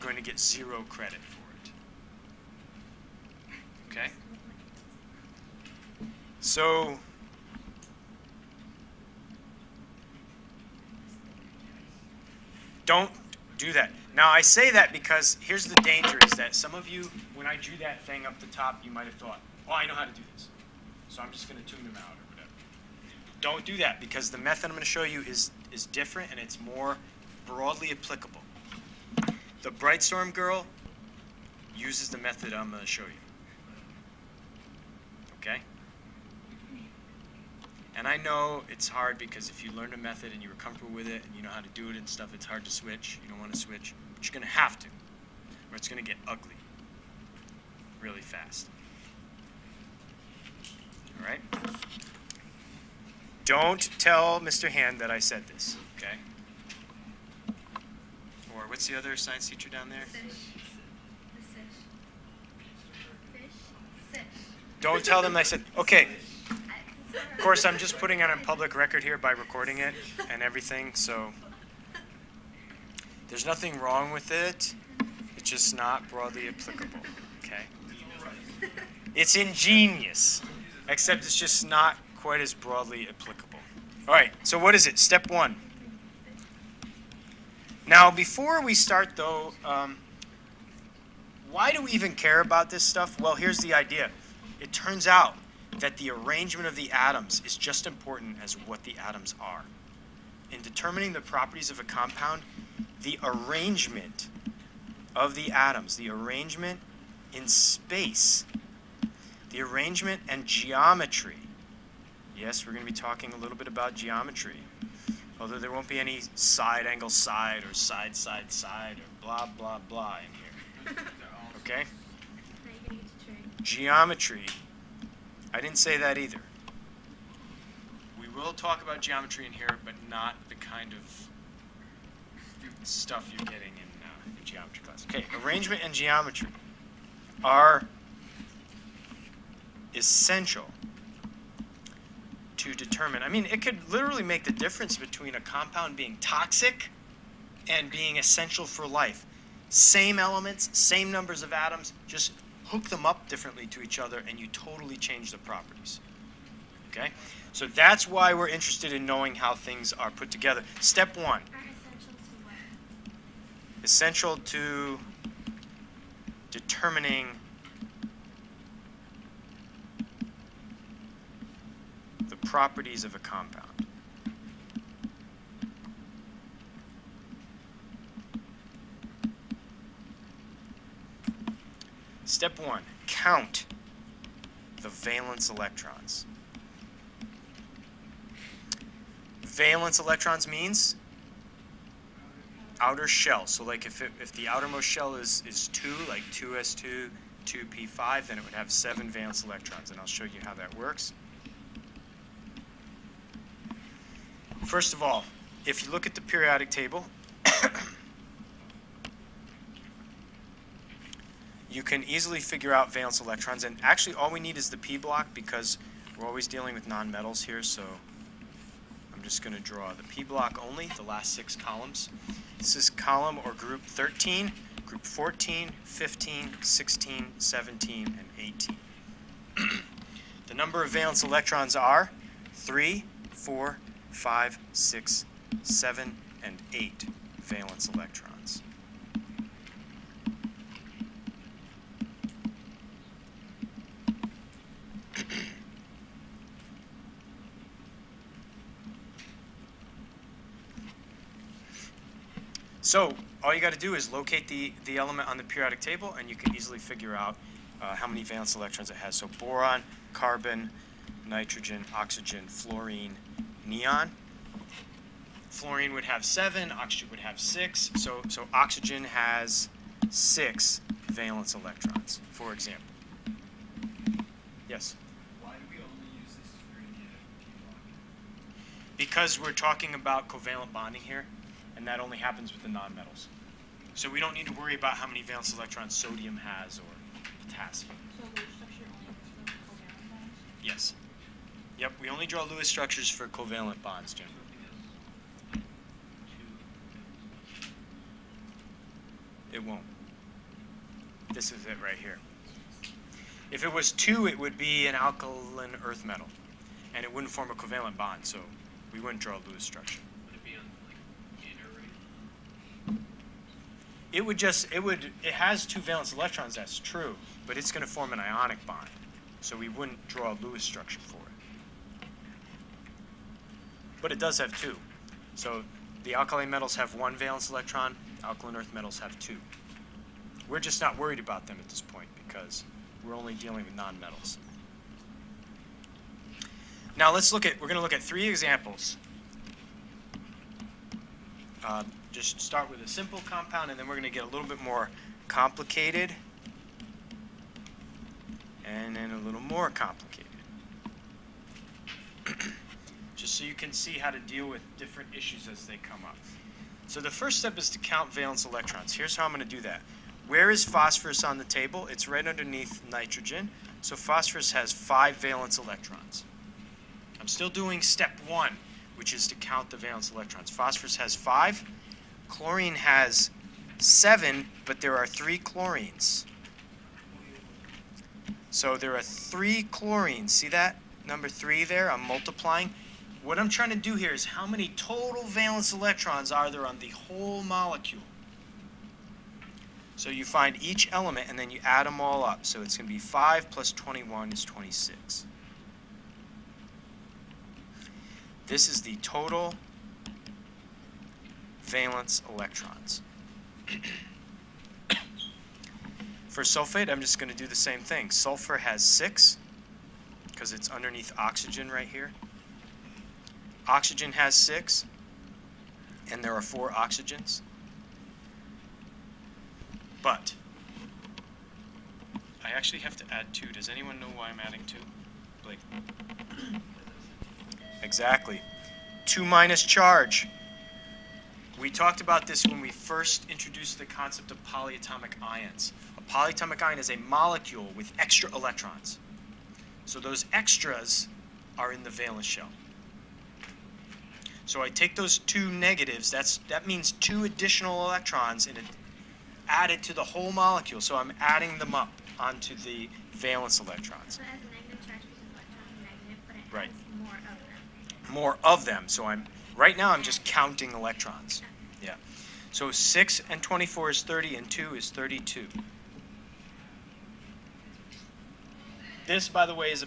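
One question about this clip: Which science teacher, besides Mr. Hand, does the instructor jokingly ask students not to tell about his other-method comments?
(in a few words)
Fish.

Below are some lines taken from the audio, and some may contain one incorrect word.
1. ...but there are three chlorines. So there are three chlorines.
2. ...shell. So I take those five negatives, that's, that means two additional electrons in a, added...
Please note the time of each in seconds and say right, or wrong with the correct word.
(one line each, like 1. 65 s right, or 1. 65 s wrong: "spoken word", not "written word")
1. 374 s right
2. 442 s wrong: "two", not "five".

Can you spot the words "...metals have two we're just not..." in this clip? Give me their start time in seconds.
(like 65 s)
328 s.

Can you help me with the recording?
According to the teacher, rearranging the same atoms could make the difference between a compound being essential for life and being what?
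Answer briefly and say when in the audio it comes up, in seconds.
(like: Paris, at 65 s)
toxic, at 146 s.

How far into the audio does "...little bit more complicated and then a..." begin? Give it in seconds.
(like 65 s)
344 s.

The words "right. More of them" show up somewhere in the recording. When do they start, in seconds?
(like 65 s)
456 s.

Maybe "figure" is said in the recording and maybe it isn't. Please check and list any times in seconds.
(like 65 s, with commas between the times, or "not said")
212 s, 256 s.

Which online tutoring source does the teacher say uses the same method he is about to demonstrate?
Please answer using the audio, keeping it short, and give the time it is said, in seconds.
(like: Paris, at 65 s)
Brightstorm, at 29 s.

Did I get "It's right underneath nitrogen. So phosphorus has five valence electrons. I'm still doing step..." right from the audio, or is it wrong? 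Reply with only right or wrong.
right.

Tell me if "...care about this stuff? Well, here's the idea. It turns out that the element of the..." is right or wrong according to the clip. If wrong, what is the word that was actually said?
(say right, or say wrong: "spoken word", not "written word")
wrong: "arrangement", not "element".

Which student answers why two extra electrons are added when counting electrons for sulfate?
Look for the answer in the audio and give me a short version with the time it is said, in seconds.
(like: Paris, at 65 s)
Blake, at 425 s.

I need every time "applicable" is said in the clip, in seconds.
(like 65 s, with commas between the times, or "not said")
27 s, 76 s, 83 s.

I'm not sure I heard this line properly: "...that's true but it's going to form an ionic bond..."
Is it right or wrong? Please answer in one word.
right.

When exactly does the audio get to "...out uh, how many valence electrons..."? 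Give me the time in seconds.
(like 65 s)
257 s.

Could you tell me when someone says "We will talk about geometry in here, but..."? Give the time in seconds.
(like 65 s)
128 s.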